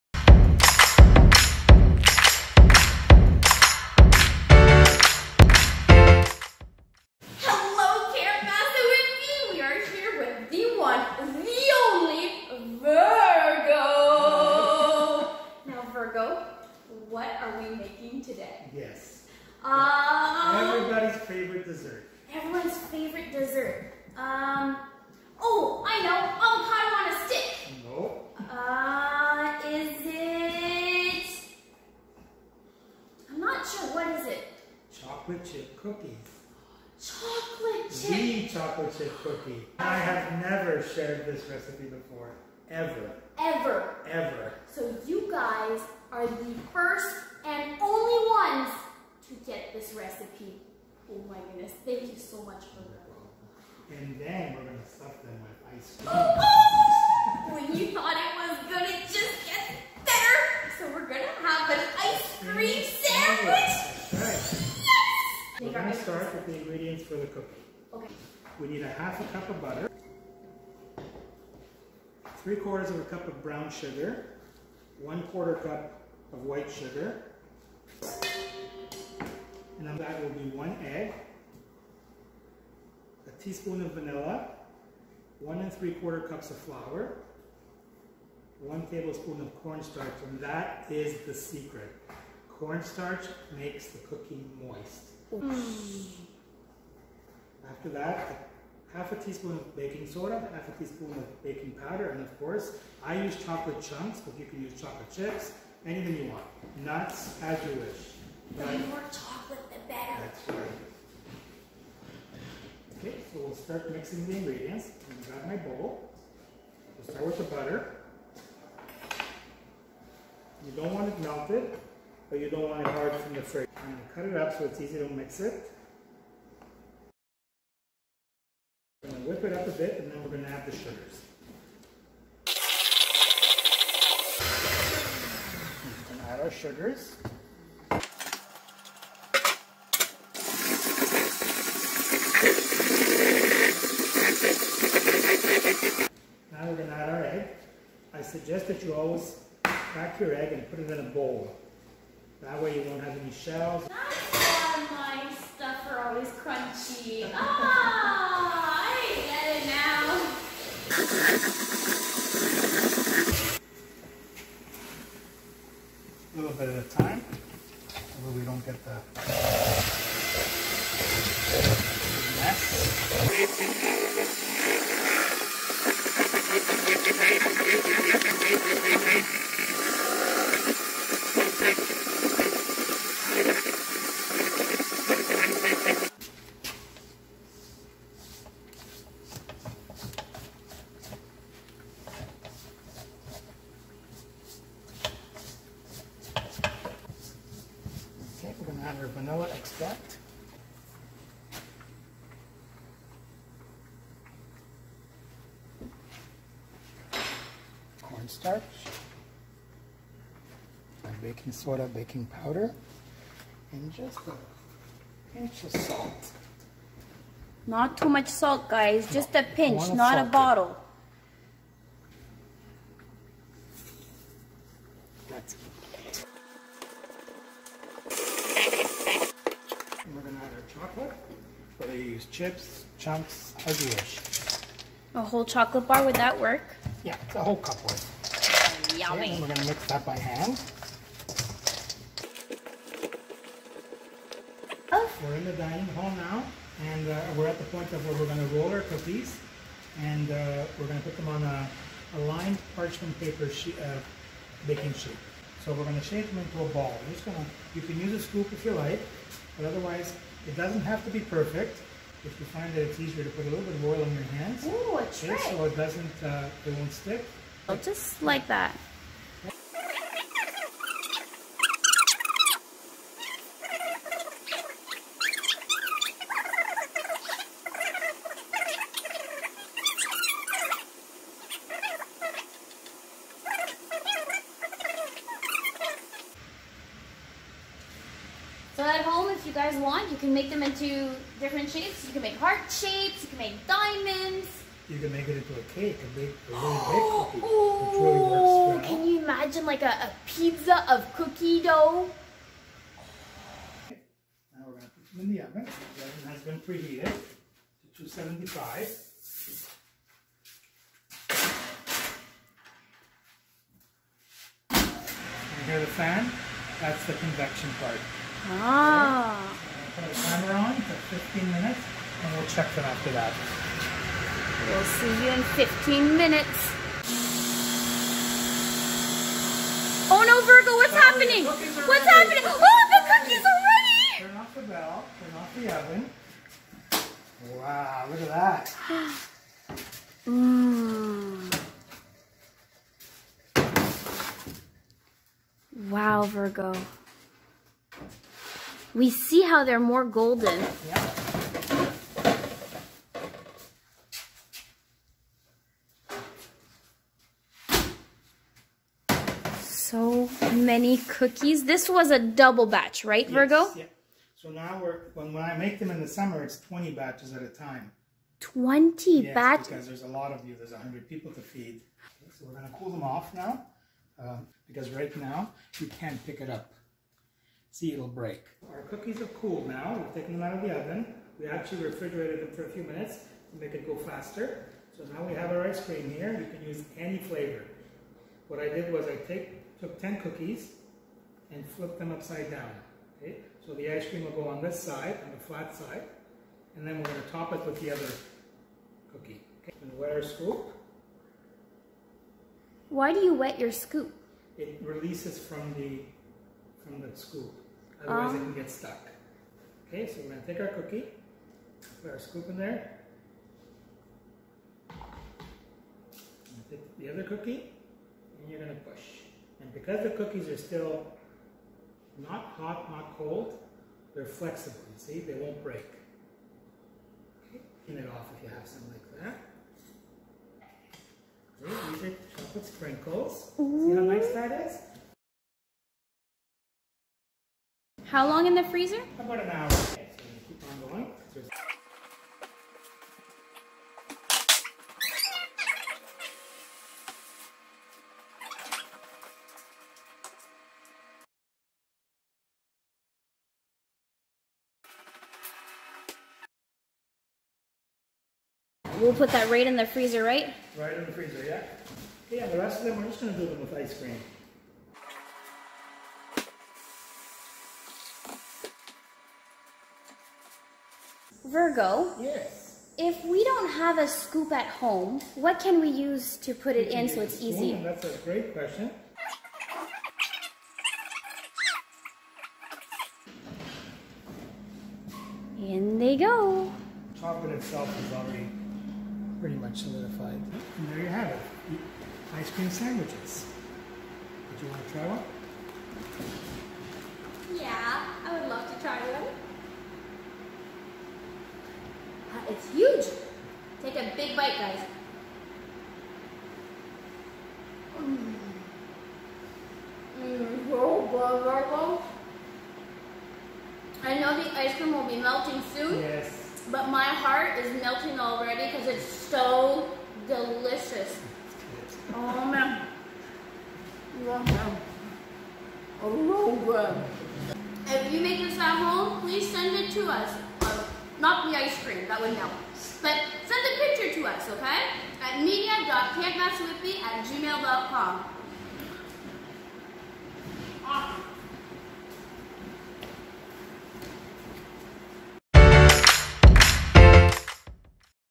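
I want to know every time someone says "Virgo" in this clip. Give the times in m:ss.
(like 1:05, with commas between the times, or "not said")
5:30, 5:46, 6:03, 7:51.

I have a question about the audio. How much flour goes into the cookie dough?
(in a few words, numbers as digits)
1 3/4 cups.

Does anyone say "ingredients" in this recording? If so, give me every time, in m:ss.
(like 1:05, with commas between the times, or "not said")
1:06, 1:54.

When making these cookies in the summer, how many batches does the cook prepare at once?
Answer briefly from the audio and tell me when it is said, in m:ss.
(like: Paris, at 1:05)
20, at 6:06.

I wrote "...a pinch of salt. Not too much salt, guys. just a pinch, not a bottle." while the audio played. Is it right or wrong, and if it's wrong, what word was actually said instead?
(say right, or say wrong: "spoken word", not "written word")
right.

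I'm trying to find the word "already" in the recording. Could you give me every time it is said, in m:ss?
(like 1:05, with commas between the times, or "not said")
8:08, 8:38.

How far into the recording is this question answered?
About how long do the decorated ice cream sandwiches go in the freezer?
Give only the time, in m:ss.
7:19.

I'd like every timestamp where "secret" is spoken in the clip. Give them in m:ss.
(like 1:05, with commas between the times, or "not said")
1:31.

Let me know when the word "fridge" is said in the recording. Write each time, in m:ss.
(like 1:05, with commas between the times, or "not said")
2:03.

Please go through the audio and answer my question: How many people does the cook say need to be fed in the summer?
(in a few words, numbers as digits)
100.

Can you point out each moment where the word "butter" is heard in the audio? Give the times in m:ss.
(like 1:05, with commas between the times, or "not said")
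1:09, 1:57.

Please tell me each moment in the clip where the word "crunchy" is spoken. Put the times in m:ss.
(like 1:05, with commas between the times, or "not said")
2:36.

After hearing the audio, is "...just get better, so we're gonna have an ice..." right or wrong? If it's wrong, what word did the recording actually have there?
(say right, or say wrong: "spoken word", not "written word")
right.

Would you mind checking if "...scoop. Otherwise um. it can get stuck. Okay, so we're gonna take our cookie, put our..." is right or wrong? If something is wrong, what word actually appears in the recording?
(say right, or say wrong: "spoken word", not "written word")
right.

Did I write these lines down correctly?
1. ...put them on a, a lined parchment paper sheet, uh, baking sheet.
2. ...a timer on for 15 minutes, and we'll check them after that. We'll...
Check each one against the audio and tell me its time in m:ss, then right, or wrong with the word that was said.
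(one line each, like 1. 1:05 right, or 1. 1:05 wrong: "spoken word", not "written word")
1. 4:11 right
2. 5:20 right.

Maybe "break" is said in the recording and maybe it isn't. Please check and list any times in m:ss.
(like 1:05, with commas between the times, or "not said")
6:18, 7:05.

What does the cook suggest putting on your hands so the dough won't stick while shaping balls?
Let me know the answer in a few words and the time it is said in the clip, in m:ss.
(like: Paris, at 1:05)
Oil, at 4:23.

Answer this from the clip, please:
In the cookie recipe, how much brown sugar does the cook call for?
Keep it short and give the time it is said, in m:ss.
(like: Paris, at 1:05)
3/4 cup, at 1:12.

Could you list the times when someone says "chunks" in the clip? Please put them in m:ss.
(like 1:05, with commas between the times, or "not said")
1:43, 3:52.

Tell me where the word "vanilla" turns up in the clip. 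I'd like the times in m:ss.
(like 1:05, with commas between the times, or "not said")
1:23, 3:19.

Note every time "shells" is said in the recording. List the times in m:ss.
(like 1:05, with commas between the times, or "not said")
2:33.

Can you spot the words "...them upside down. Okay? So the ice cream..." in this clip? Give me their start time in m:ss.
6:31.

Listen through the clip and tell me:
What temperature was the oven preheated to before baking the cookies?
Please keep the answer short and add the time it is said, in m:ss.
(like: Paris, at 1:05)
275, at 5:08.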